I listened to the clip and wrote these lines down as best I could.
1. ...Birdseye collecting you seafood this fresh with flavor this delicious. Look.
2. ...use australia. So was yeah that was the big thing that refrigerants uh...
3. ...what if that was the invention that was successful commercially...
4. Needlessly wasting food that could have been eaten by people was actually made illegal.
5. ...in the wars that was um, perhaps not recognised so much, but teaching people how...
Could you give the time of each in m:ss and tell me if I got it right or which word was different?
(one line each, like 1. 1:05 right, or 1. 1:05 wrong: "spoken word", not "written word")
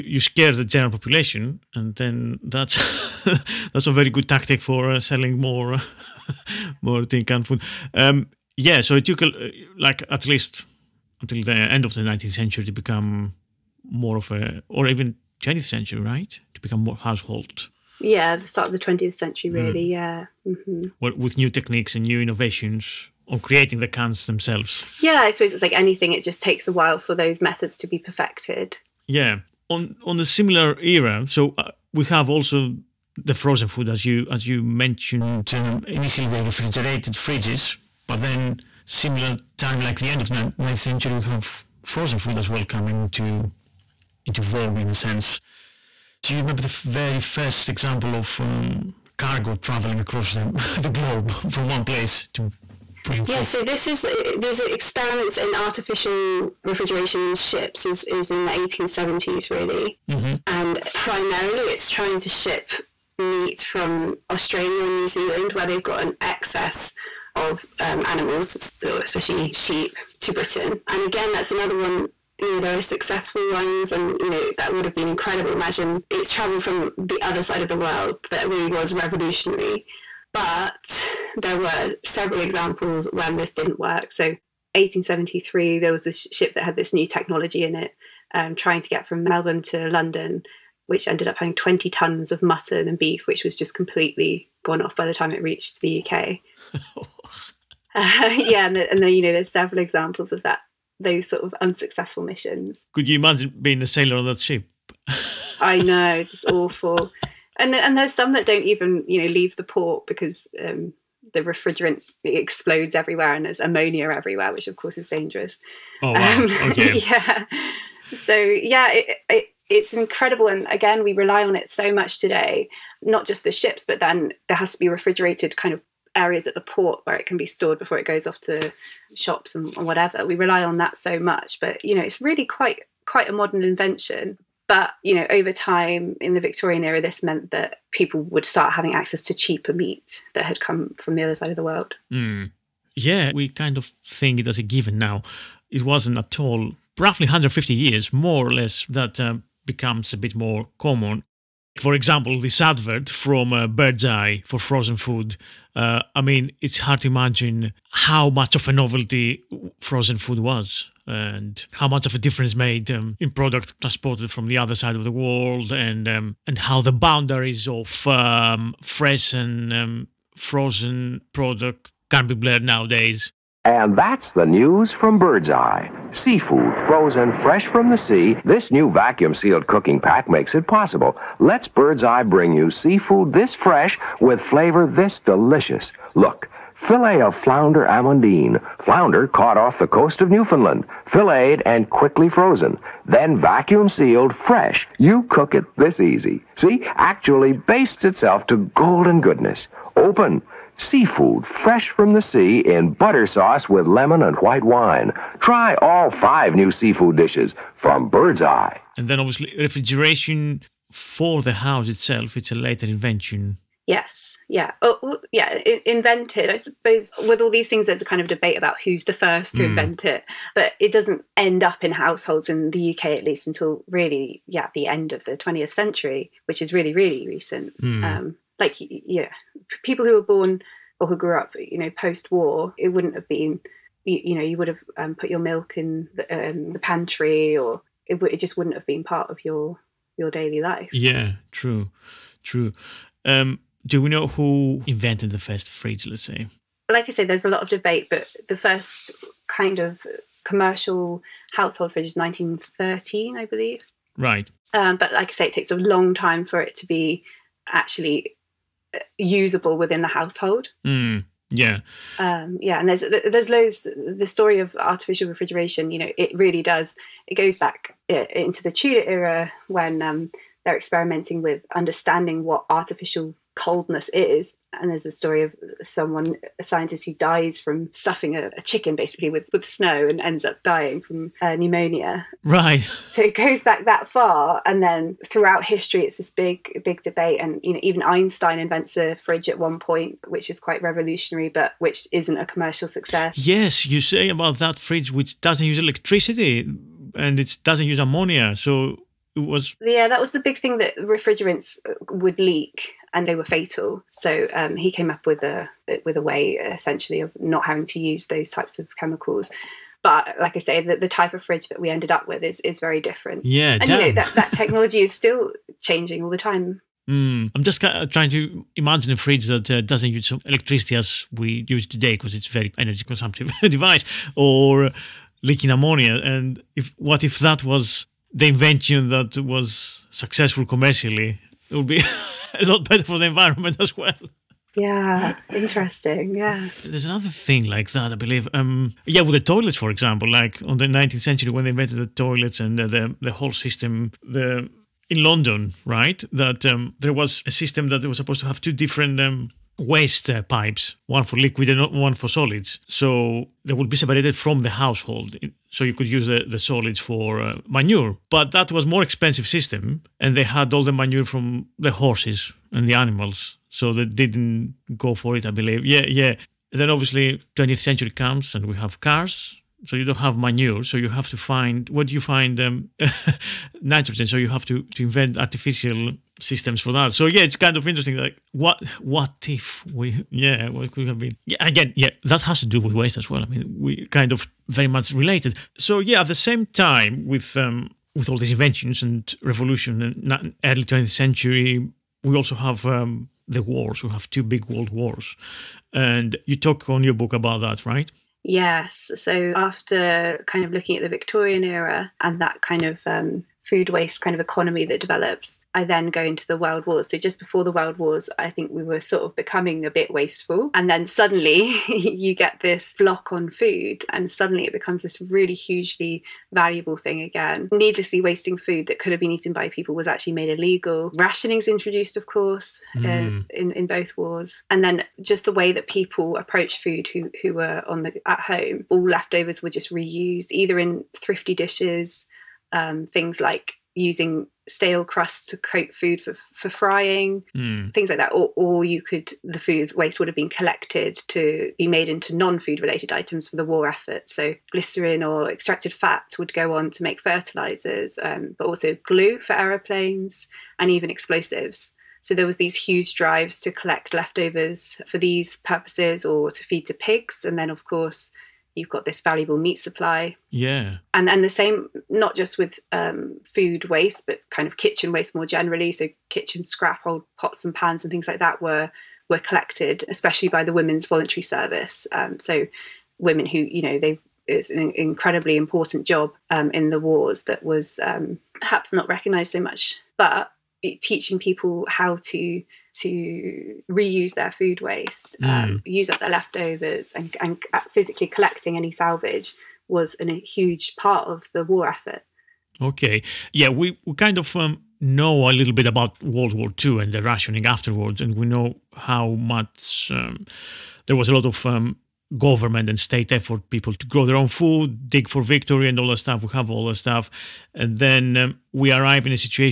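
1. 3:01 wrong: "bring", not "collecting"
2. 4:57 wrong: "ammonia", not "australia"
3. 5:26 right
4. 6:57 right
5. 7:56 right.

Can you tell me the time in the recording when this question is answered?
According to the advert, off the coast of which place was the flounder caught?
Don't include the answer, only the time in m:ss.
3:10.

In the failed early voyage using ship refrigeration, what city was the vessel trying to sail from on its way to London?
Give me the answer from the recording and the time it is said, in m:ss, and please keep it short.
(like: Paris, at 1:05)
Melbourne, at 1:29.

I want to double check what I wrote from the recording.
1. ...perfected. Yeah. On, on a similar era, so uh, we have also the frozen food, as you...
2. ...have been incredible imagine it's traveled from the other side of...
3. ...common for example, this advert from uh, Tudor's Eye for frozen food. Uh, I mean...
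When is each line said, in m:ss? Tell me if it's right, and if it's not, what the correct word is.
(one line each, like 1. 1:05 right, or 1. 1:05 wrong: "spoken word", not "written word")
1. 0:27 right
2. 1:14 right
3. 2:30 wrong: "Bird", not "Tudor".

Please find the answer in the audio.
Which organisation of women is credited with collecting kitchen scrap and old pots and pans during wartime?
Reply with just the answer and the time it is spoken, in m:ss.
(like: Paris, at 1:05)
women's voluntary service, at 7:50.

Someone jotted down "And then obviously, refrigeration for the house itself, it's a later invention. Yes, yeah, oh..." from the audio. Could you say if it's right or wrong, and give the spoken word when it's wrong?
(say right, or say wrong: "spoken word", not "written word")
right.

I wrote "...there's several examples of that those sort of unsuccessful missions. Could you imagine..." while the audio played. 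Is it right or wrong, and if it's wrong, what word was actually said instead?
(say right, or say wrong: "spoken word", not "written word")
right.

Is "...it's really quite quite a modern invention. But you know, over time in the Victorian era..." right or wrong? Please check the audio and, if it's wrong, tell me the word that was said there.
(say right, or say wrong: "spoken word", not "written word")
right.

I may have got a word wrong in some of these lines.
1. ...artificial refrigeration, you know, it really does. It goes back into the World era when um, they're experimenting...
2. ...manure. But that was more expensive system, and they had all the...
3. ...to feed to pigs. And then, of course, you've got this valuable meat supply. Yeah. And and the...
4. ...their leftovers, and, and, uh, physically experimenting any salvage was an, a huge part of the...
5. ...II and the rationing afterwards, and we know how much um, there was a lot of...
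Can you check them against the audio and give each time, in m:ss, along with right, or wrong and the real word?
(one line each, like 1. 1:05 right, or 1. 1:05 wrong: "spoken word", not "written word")
1. 4:24 wrong: "Tudor", not "World"
2. 5:57 right
3. 7:36 right
4. 8:06 wrong: "collecting", not "experimenting"
5. 8:16 right.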